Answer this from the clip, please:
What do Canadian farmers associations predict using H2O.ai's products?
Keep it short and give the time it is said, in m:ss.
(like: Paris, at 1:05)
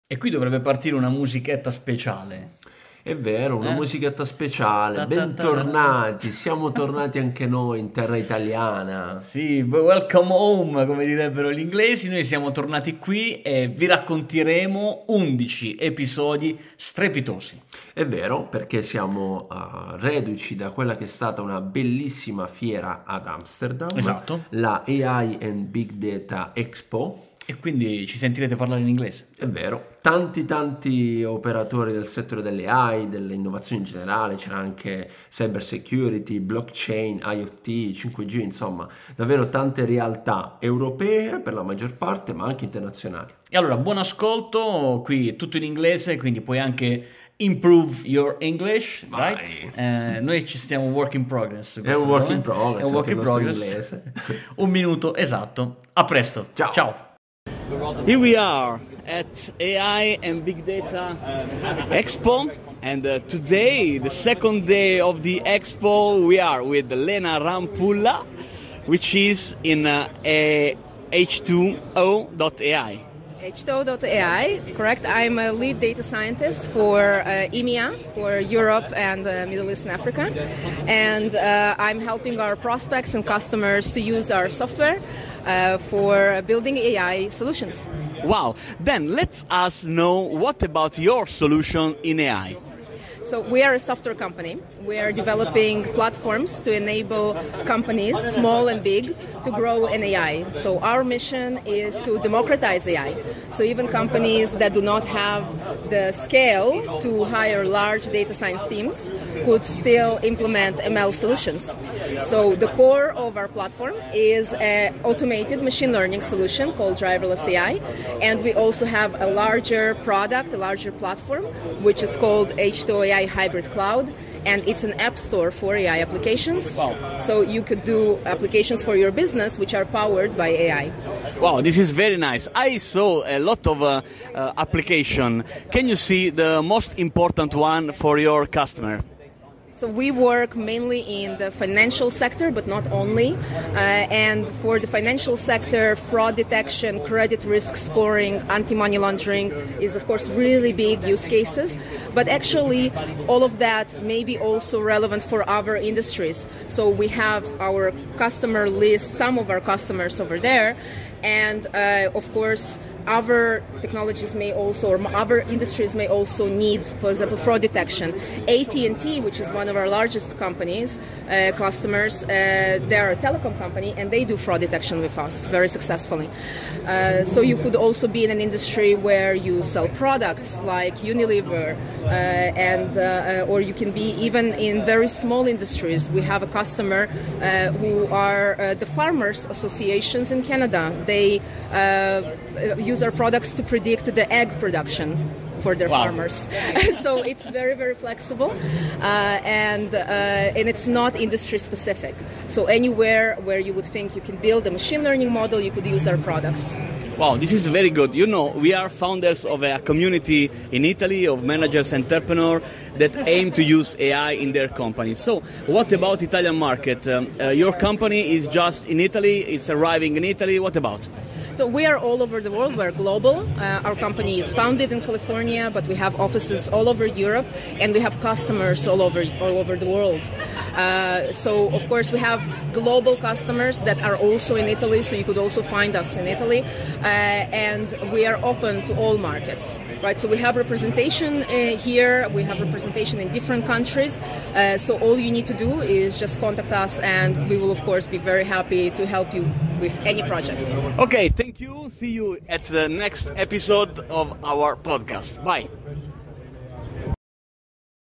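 Egg production, at 3:14.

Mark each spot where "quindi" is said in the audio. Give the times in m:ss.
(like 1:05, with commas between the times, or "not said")
0:27, 0:46.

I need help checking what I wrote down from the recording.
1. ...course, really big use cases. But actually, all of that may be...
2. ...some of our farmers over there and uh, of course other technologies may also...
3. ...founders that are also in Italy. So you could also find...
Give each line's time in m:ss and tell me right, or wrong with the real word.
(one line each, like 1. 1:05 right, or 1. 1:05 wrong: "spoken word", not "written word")
1. 2:30 right
2. 2:39 wrong: "customers", not "farmers"
3. 3:53 wrong: "customers", not "founders".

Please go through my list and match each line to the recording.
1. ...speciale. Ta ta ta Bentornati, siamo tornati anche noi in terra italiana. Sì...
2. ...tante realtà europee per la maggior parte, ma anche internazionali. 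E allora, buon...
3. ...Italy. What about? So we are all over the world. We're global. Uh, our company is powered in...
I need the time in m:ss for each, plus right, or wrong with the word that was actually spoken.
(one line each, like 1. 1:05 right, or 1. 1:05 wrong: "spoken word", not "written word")
1. 0:04 right
2. 0:39 right
3. 3:40 wrong: "founded", not "powered".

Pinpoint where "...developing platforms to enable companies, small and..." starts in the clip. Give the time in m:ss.
1:35.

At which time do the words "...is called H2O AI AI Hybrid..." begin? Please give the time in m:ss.
2:02.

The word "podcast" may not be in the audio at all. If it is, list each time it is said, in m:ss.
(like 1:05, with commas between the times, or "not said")
4:14.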